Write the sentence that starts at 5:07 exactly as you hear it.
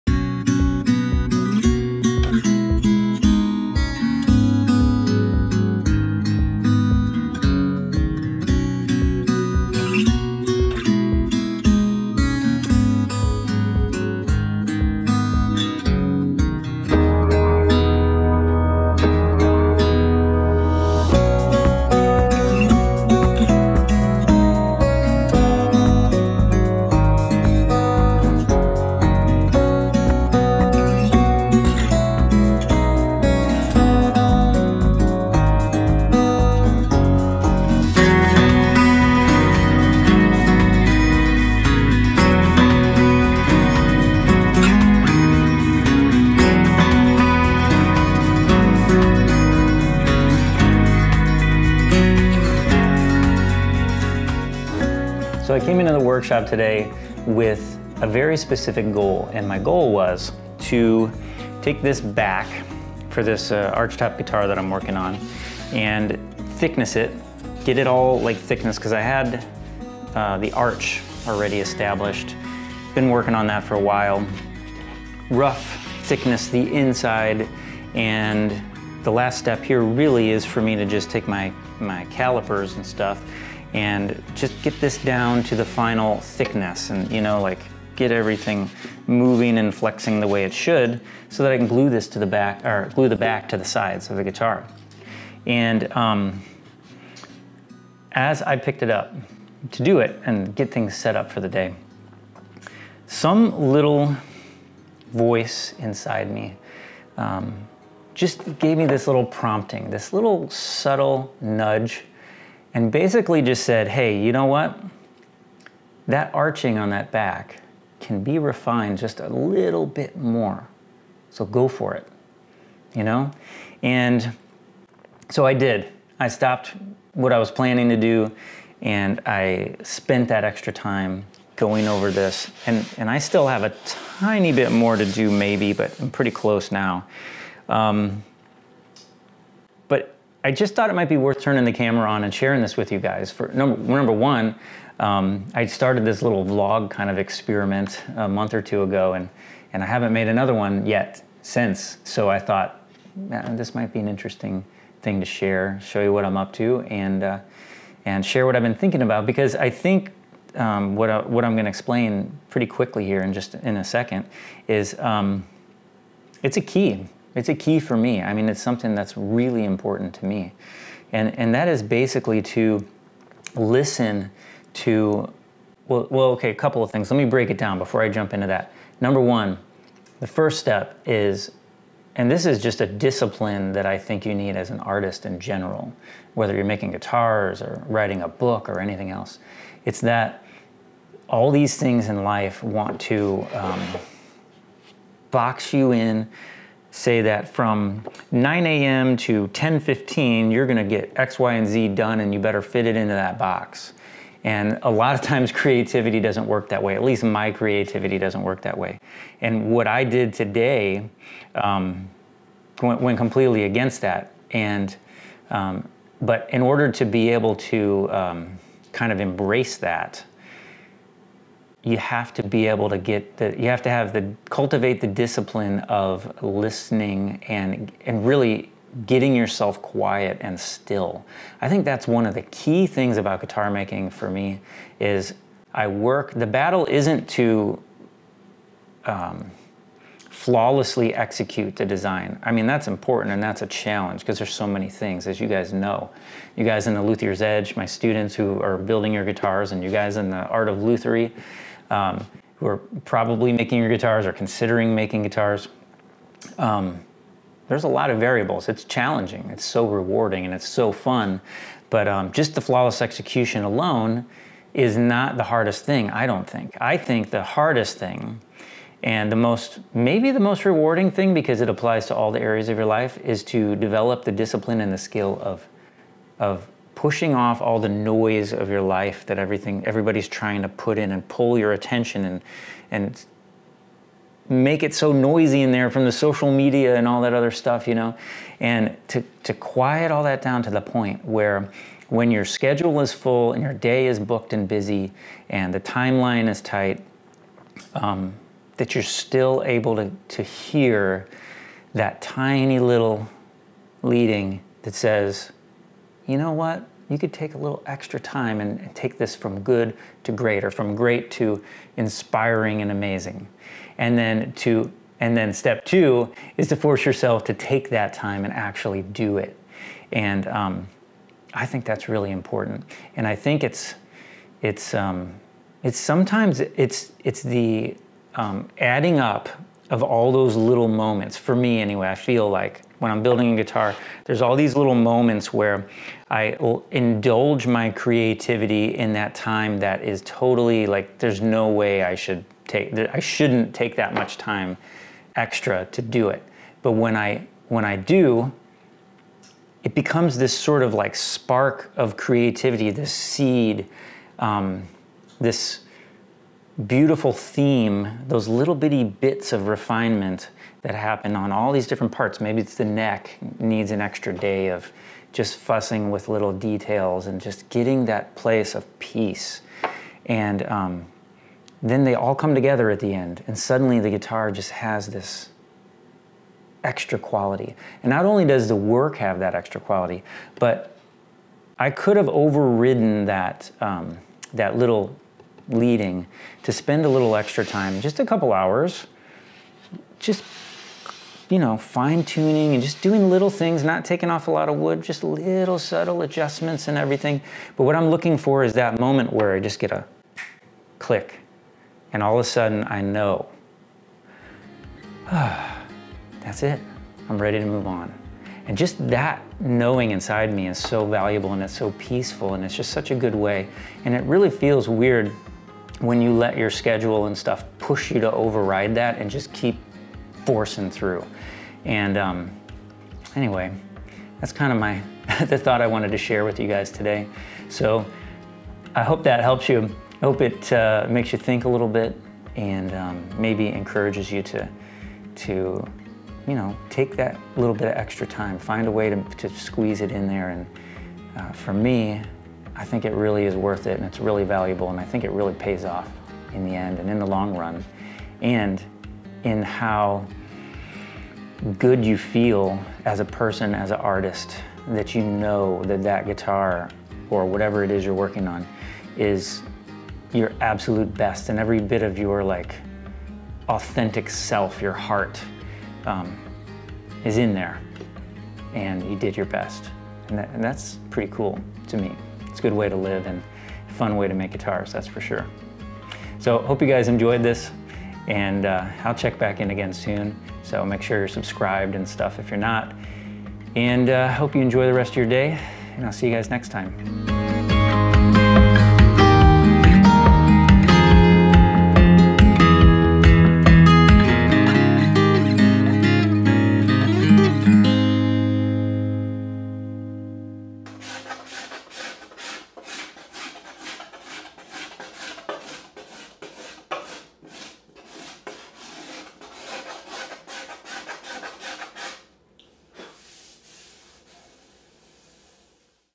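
You could take a little extra time and, take this from good to great or from great to inspiring and amazing.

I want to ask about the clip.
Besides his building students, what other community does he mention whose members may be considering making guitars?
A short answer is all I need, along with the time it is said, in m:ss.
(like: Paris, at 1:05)
Art of Lutherie, at 4:10.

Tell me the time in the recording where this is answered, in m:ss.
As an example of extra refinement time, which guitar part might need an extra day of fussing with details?
6:02.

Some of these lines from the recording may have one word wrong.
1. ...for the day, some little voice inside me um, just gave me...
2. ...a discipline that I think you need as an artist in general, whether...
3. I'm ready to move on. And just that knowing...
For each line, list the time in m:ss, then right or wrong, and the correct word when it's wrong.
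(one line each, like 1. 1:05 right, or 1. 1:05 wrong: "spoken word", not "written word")
1. 1:41 right
2. 3:02 right
3. 6:47 right.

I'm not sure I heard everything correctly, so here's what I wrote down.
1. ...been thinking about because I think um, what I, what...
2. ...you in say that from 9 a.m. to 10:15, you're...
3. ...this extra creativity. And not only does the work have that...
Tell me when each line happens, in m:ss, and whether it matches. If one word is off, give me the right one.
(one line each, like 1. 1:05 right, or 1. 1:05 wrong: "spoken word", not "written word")
1. 2:38 right
2. 3:15 right
3. 6:15 wrong: "quality", not "creativity".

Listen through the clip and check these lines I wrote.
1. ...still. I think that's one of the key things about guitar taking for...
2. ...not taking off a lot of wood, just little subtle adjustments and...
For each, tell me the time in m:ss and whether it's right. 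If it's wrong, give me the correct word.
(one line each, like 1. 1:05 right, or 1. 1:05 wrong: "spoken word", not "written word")
1. 3:50 wrong: "making", not "taking"
2. 6:33 right.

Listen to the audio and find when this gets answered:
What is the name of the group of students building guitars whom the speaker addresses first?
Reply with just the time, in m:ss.
4:07.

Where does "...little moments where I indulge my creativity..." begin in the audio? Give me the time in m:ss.
5:34.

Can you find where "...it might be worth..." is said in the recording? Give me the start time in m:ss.
2:20.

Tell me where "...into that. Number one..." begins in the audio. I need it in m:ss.
2:58.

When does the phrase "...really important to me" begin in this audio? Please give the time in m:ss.
2:49.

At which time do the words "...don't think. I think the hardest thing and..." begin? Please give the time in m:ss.
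4:26.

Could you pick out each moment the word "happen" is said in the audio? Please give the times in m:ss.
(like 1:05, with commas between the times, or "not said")
6:00.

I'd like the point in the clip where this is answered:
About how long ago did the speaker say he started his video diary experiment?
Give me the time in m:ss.
2:28.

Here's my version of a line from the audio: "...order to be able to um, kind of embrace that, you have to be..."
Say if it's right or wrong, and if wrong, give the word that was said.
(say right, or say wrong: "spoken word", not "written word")
right.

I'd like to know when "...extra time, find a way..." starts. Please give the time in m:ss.
7:17.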